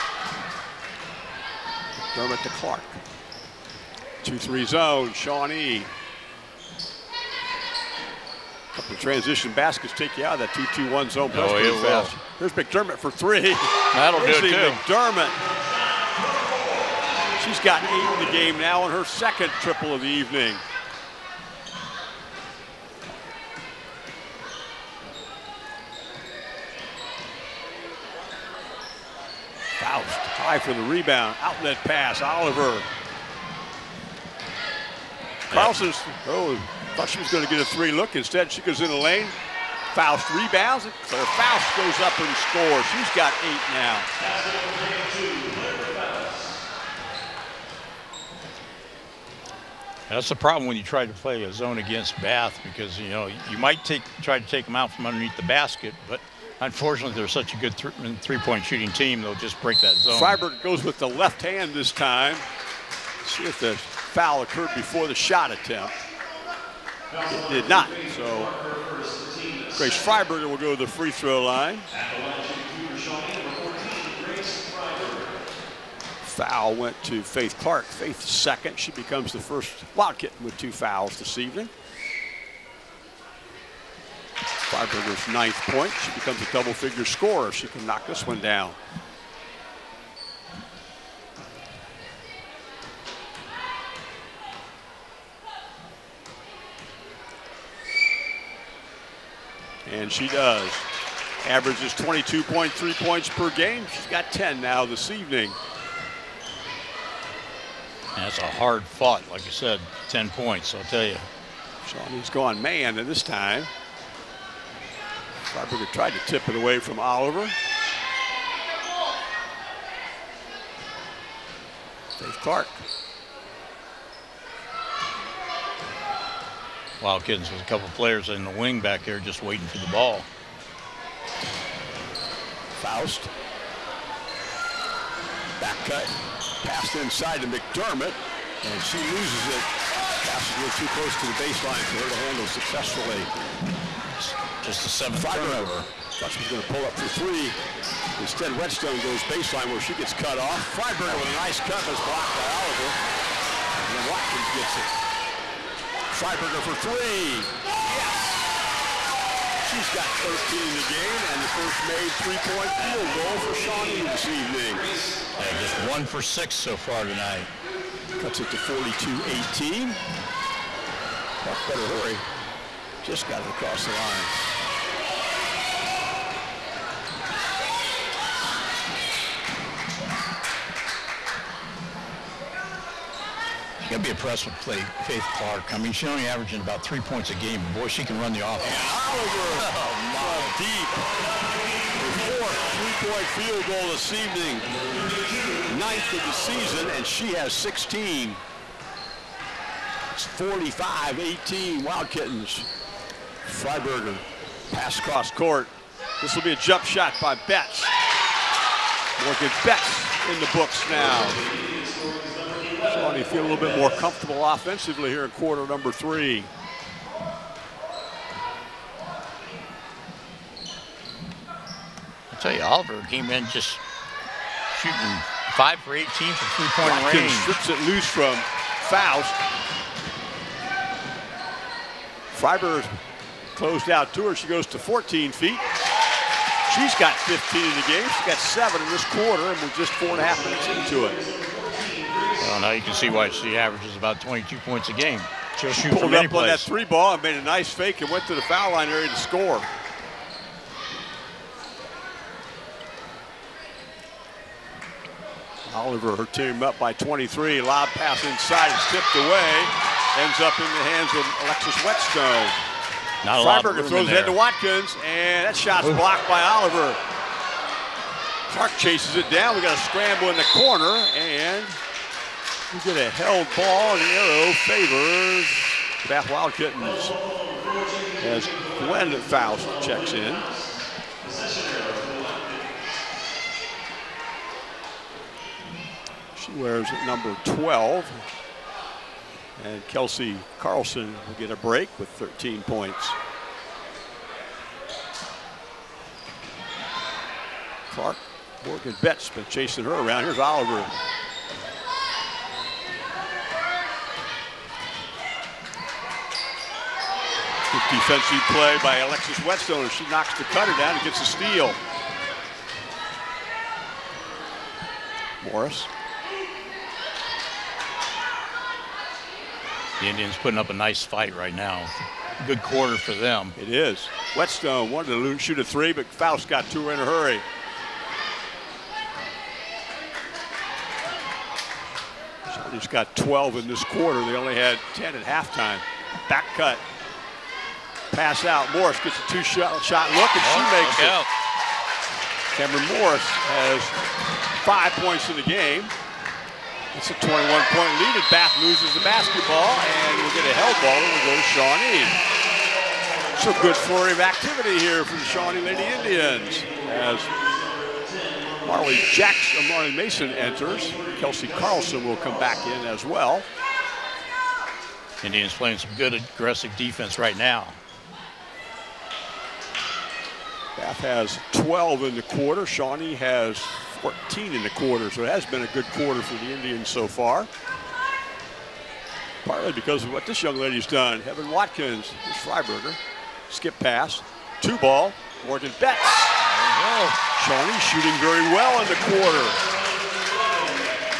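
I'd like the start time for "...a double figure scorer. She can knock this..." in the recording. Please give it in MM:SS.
01:26.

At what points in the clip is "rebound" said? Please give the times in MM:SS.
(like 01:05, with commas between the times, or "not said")
00:30, 00:40.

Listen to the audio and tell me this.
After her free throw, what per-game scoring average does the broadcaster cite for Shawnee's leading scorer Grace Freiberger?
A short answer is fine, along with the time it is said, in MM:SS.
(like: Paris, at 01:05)
22.3, at 01:41.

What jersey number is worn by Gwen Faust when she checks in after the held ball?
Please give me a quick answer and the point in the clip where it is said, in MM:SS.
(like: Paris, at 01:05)
12, at 04:47.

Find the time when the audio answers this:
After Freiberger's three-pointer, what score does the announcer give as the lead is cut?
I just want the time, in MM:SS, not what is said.
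02:48.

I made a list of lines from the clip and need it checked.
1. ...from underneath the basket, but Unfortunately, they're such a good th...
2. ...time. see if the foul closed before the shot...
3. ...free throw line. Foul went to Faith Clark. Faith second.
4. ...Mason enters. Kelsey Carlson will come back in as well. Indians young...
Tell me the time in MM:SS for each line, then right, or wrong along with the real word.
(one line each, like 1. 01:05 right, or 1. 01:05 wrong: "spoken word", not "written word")
1. 00:54 right
2. 01:01 wrong: "occurred", not "closed"
3. 01:10 right
4. 05:59 wrong: "playing", not "young".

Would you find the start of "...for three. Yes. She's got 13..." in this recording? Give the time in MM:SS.
02:36.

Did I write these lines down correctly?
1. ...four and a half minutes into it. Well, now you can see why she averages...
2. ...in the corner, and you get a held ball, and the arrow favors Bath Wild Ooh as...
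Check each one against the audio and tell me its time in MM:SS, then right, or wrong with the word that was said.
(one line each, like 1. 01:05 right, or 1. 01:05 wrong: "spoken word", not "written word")
1. 03:59 right
2. 04:30 wrong: "Kittens", not "Ooh".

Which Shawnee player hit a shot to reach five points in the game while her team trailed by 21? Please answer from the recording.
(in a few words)
Cameron Morris.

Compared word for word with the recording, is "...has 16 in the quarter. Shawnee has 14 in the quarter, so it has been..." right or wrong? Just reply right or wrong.
wrong.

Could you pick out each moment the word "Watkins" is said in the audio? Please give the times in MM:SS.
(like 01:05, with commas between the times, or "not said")
02:34, 04:24, 06:21.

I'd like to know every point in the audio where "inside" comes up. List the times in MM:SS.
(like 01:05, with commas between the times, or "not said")
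02:16, 04:18.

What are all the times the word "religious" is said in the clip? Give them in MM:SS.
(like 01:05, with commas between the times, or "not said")
not said.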